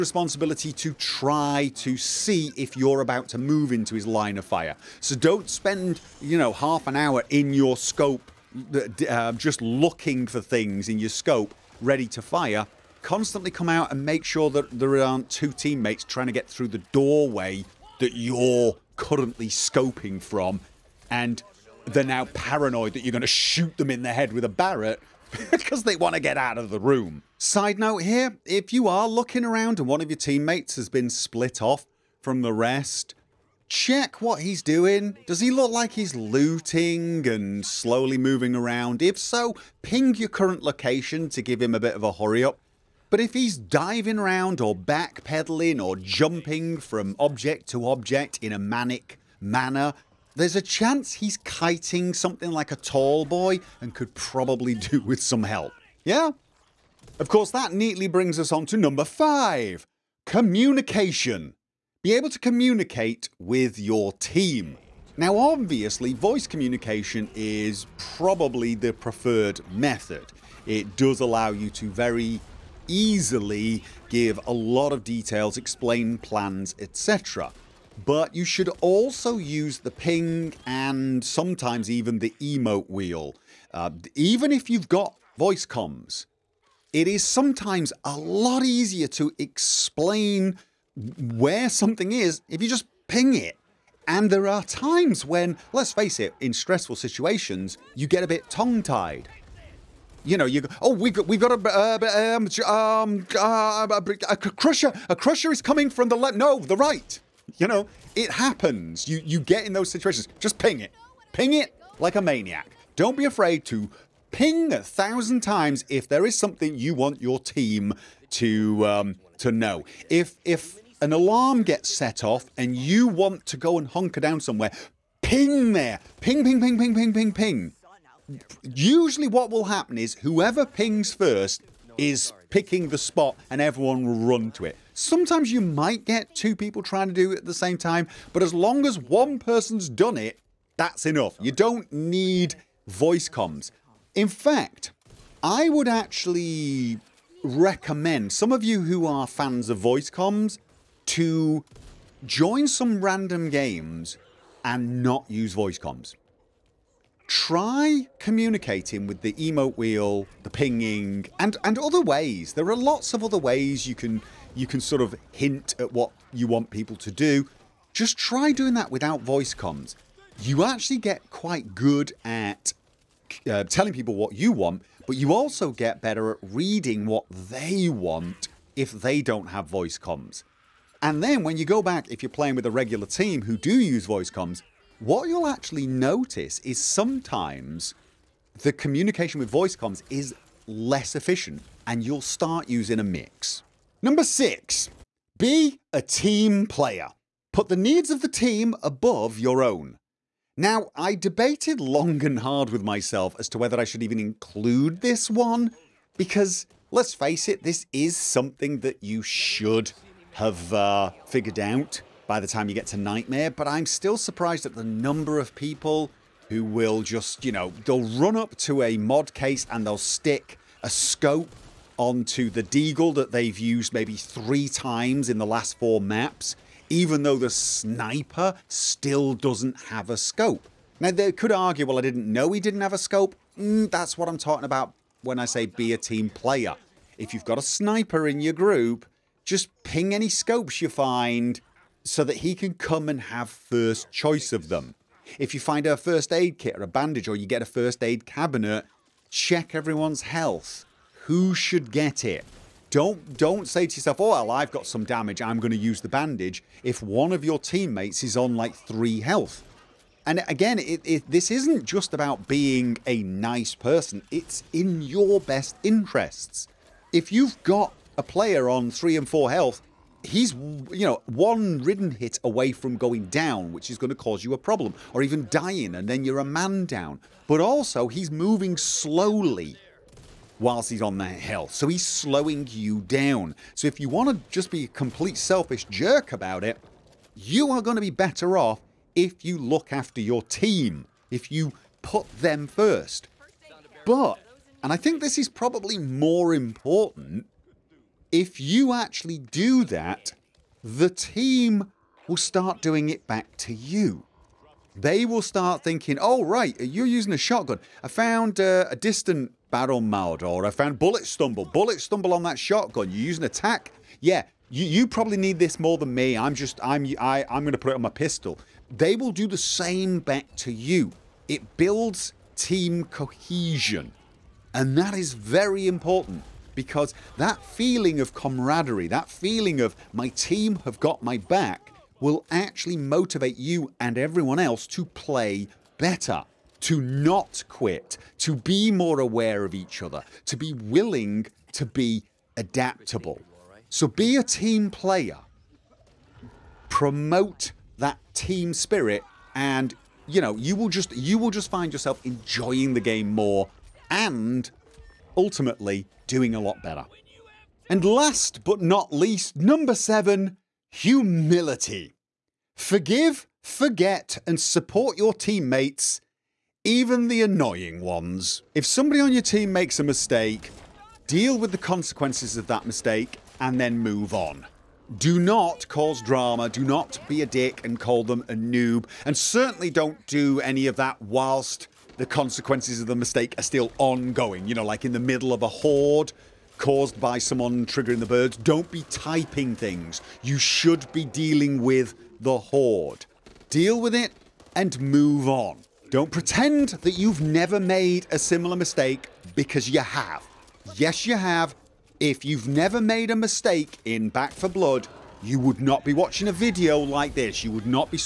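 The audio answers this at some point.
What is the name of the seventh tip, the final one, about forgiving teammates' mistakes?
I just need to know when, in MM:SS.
06:00.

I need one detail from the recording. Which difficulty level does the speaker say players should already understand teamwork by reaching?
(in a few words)
Nightmare.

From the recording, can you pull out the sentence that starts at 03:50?
Now they could argue well I didn't know he didn't have a scope.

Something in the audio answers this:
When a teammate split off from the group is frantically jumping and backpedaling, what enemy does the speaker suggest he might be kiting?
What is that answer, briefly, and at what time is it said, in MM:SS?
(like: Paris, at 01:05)
Tall boy, at 00:52.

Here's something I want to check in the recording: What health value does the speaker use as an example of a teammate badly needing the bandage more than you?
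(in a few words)
3.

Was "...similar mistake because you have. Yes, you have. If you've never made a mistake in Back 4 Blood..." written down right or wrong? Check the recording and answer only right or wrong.
right.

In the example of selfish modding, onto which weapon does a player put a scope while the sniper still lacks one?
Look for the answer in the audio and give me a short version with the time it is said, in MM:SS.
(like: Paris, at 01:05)
Deagle, at 03:42.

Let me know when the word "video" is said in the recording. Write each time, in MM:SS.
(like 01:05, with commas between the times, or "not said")
06:46.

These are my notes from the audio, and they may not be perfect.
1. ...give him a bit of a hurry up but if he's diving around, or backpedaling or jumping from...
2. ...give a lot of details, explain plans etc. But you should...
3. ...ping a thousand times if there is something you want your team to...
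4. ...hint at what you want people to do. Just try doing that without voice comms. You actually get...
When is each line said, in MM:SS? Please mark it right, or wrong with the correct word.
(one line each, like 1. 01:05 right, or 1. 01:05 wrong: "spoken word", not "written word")
1. 00:41 right
2. 01:14 right
3. 01:54 right
4. 02:45 right.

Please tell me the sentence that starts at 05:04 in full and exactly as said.
They will start thinking, oh, right, you're using a shotgun.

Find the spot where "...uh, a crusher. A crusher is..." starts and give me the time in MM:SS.
01:43.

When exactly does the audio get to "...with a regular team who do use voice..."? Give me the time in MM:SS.
03:02.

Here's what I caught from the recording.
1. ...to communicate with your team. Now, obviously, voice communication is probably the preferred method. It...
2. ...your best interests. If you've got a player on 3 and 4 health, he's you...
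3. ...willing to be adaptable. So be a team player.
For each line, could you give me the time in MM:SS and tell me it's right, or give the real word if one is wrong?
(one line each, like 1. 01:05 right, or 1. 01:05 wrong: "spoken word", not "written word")
1. 01:02 right
2. 04:25 right
3. 05:40 right.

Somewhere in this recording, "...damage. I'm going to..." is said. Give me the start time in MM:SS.
04:15.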